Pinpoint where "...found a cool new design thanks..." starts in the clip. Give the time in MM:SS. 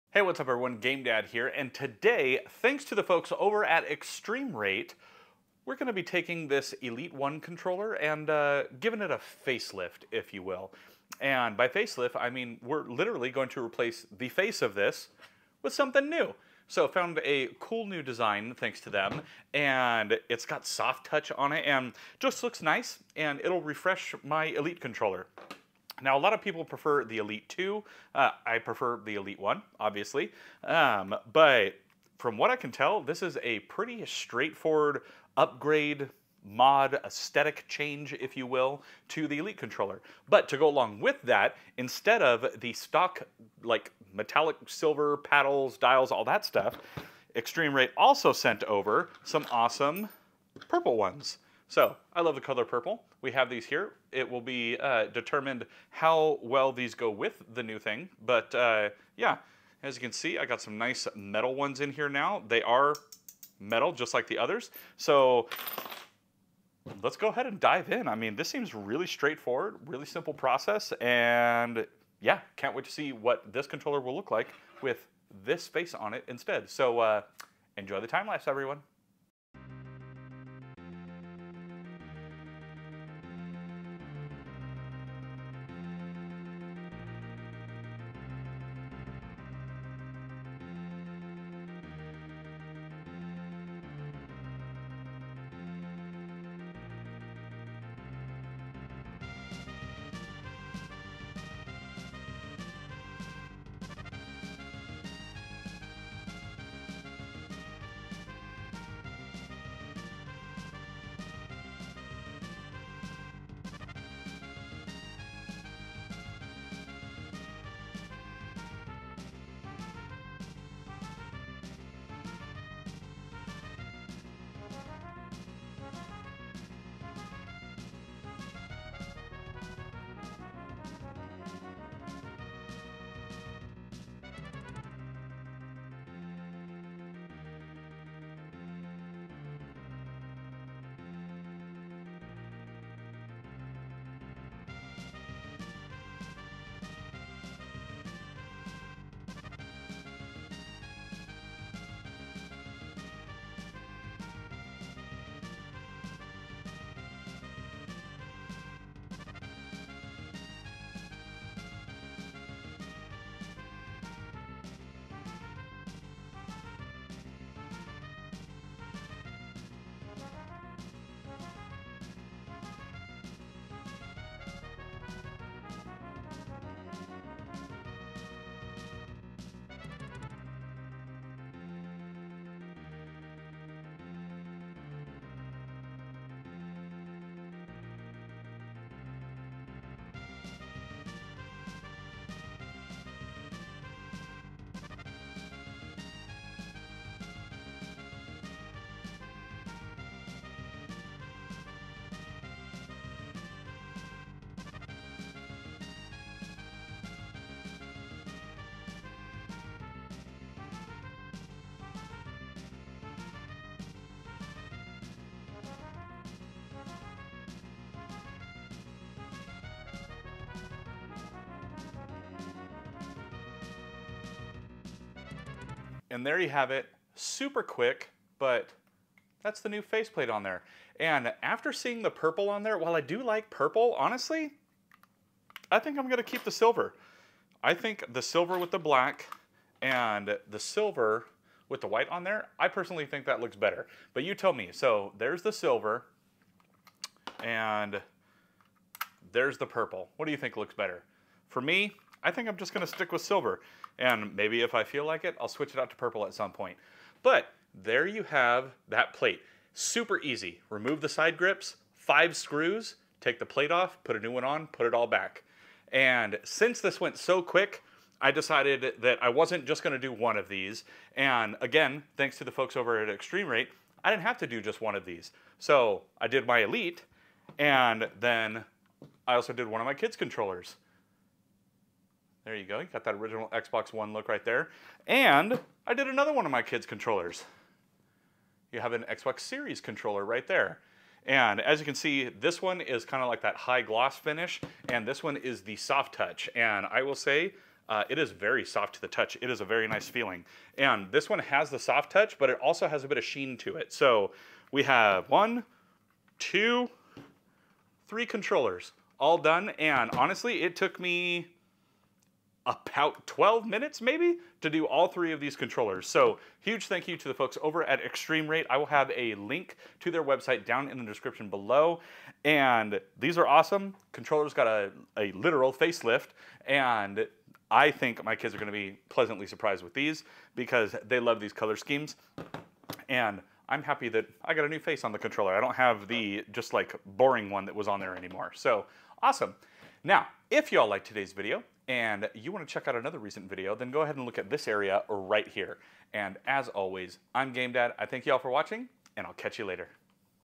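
00:16.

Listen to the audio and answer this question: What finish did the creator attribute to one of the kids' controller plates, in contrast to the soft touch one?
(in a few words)
High gloss.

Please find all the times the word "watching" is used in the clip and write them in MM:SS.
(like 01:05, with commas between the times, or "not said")
05:48.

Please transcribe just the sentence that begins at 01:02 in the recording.
They are metal, just like the others.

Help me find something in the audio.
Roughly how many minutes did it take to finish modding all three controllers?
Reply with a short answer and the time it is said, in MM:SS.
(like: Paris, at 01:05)
12, at 05:12.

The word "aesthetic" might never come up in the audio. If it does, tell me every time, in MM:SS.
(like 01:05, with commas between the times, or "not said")
00:37.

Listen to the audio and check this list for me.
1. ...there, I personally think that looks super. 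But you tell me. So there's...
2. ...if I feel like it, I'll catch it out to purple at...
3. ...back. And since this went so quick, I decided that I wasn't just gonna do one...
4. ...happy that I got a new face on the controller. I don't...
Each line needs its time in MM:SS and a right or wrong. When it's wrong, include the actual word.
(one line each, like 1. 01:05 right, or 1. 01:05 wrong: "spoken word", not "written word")
1. 04:02 wrong: "better", not "super"
2. 04:14 wrong: "switch", not "catch"
3. 04:25 right
4. 05:33 right.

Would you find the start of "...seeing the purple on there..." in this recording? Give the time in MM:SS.
03:51.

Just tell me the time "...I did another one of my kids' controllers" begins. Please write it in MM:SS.
04:45.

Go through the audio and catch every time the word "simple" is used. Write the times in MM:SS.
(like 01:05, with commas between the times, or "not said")
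01:10.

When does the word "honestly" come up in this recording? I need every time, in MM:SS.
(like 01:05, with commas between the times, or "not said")
03:53, 05:10.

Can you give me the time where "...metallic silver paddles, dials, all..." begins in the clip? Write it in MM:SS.
00:44.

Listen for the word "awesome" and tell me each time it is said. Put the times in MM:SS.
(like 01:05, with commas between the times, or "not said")
00:49, 05:23, 05:39.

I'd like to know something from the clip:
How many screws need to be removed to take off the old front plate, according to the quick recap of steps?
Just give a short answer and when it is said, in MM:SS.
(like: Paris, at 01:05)
5, at 04:21.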